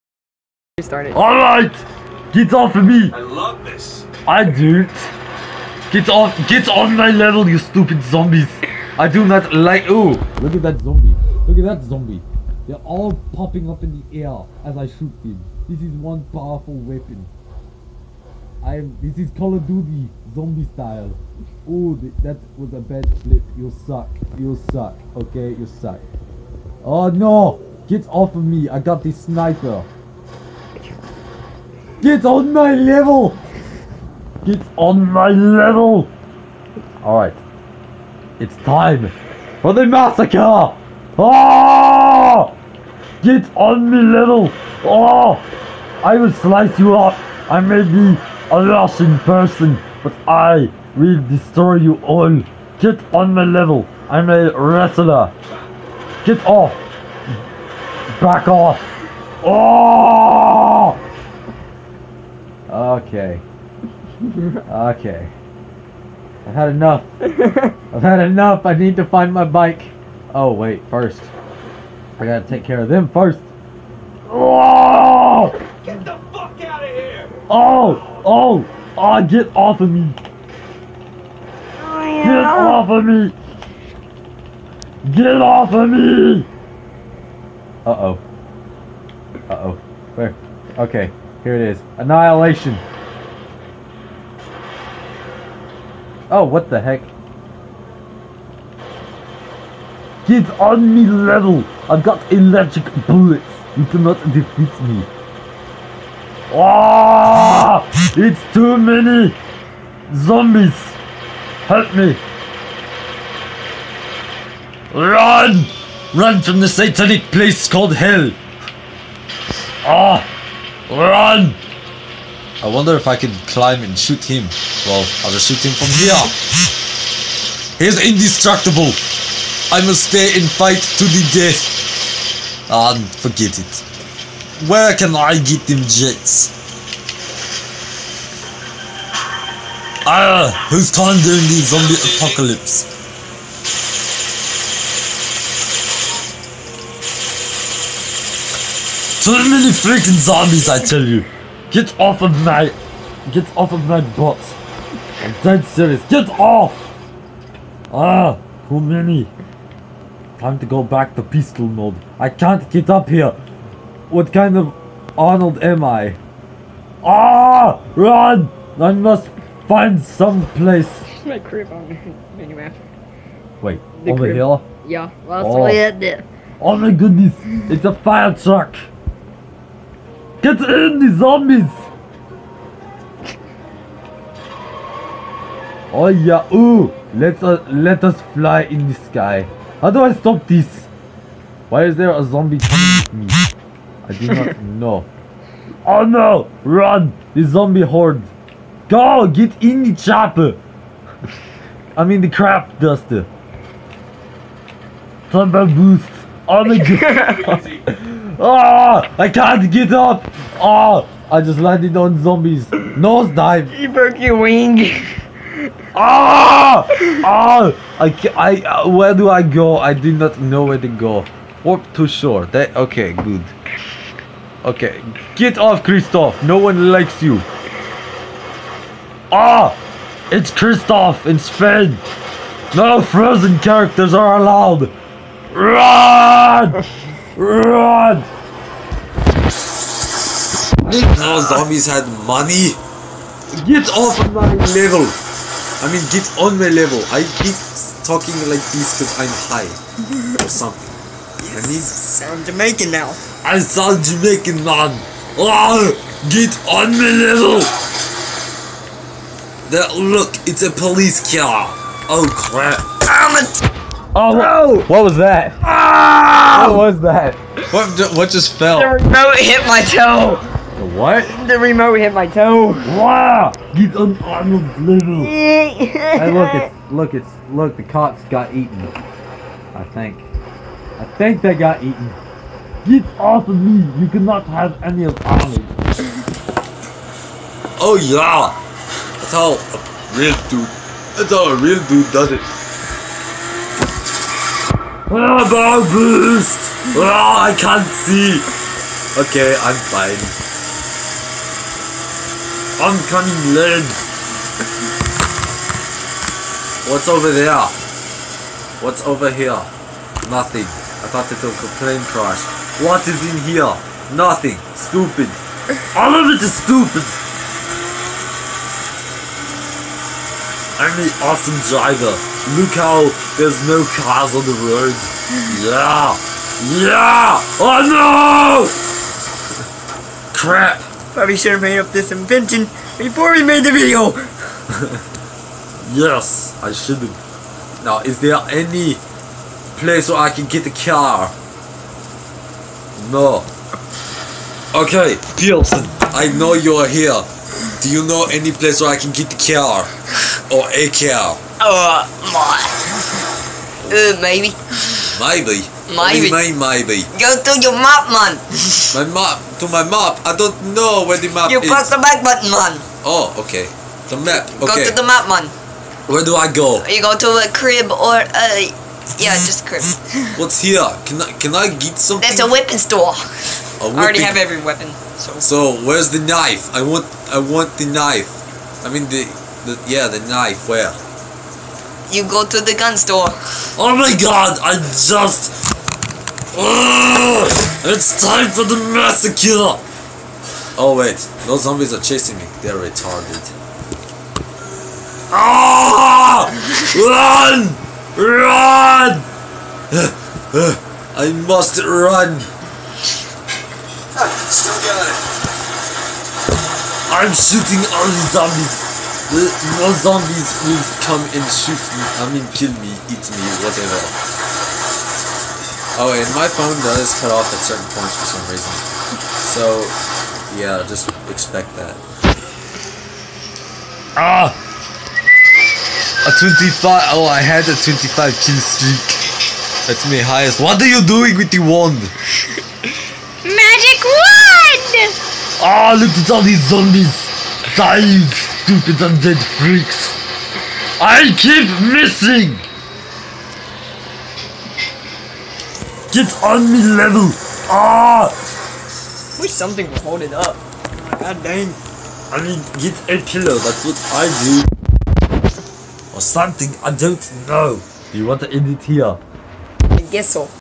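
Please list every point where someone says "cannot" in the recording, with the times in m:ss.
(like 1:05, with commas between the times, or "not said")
1:43, 4:44.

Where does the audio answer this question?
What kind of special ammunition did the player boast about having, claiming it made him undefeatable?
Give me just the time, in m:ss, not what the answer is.
1:42.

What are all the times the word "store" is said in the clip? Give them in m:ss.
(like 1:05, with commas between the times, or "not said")
6:12, 6:22.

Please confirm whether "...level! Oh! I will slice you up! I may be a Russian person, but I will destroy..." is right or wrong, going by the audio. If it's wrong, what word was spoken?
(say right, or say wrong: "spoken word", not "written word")
right.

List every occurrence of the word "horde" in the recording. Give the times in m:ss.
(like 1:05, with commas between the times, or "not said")
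3:17.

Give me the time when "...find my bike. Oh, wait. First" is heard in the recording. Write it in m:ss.
1:09.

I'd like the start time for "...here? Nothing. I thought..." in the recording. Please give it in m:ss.
5:09.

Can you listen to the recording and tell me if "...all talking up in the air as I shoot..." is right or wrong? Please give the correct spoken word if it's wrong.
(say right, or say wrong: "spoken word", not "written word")
wrong: "popping", not "talking".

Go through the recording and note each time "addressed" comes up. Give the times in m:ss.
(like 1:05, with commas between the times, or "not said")
not said.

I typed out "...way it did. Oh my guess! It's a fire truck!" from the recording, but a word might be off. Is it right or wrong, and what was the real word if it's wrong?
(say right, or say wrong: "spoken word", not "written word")
wrong: "goodness", not "guess".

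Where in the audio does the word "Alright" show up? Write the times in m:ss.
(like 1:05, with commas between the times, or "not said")
0:01, 0:37.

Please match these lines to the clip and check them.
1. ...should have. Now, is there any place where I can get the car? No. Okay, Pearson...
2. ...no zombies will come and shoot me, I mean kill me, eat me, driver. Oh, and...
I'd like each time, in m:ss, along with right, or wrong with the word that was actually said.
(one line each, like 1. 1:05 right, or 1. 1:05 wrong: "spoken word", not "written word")
1. 5:36 right
2. 6:49 wrong: "whatever", not "driver".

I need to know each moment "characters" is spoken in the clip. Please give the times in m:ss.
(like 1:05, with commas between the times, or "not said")
3:53.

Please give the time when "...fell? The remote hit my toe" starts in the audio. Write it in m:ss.
4:28.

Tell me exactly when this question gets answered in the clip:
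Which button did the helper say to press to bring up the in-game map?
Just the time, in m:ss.
6:02.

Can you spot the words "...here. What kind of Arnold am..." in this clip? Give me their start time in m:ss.
2:43.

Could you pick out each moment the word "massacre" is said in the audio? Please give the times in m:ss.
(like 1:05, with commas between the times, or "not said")
0:39, 6:28.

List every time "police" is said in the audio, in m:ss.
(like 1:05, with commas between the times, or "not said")
4:20.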